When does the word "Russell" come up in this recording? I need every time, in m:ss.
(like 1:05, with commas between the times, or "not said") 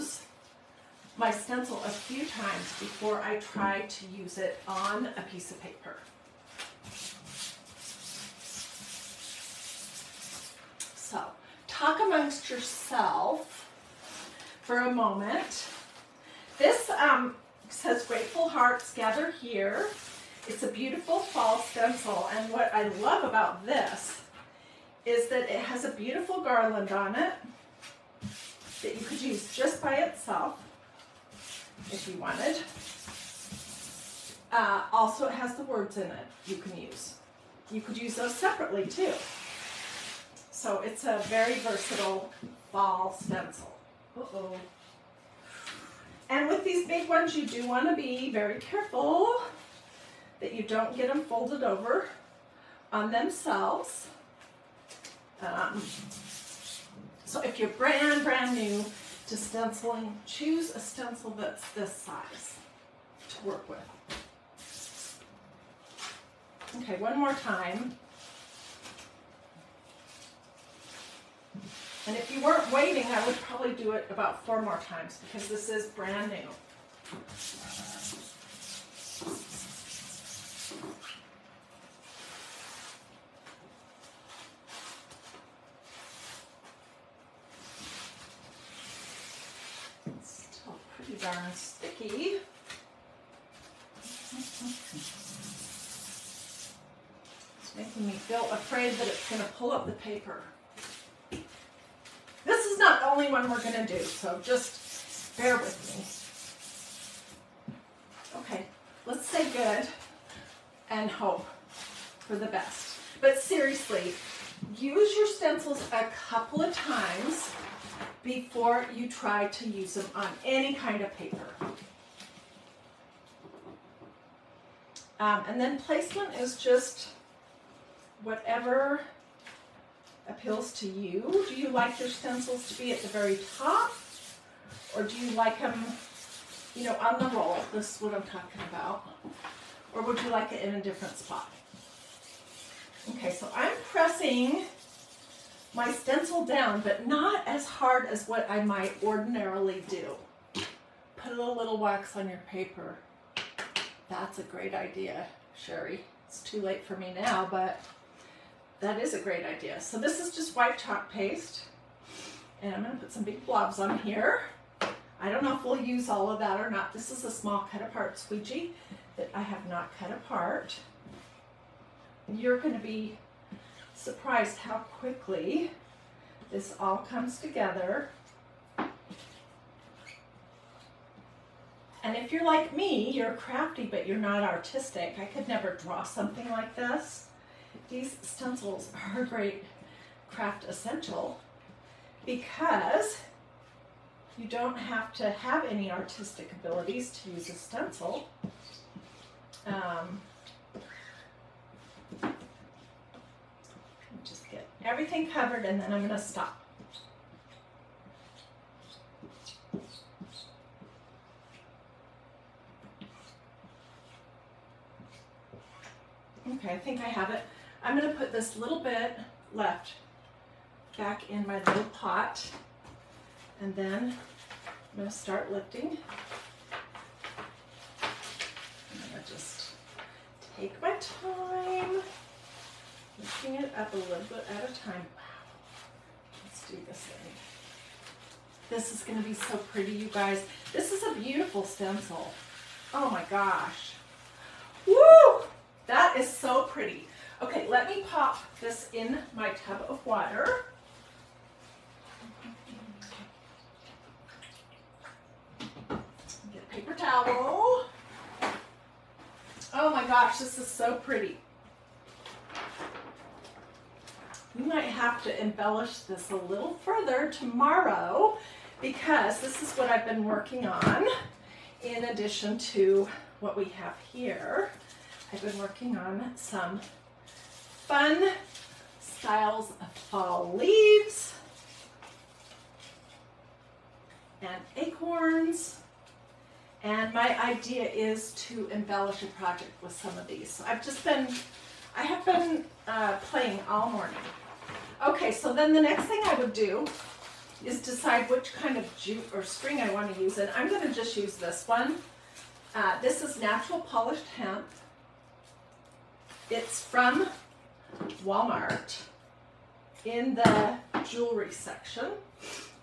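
not said.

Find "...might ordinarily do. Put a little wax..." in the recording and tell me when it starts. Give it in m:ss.
2:28.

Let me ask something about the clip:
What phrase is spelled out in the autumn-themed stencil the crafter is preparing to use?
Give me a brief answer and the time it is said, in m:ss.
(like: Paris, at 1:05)
Grateful Hearts Gather Here, at 0:18.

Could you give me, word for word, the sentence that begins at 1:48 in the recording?
Okay, let's say good and hope for the best.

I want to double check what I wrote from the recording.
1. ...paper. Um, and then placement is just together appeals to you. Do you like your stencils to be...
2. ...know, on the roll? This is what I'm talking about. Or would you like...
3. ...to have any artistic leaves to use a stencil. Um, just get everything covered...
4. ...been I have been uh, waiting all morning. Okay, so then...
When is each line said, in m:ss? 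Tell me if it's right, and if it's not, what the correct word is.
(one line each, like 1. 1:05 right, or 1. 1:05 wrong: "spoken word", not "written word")
1. 2:01 wrong: "whatever", not "together"
2. 2:16 right
3. 3:15 wrong: "abilities", not "leaves"
4. 4:51 wrong: "playing", not "waiting".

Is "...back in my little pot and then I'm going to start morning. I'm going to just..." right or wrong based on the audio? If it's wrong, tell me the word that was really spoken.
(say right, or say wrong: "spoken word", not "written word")
wrong: "lifting", not "morning".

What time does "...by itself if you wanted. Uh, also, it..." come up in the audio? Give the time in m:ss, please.
0:29.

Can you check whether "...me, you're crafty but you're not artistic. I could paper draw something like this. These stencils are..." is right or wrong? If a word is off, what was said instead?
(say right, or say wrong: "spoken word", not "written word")
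wrong: "never", not "paper".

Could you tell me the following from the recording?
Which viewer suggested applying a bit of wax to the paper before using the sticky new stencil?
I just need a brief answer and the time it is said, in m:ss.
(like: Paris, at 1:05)
Sherry, at 2:35.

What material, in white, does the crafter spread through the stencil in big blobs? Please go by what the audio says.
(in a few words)
Chalk paste.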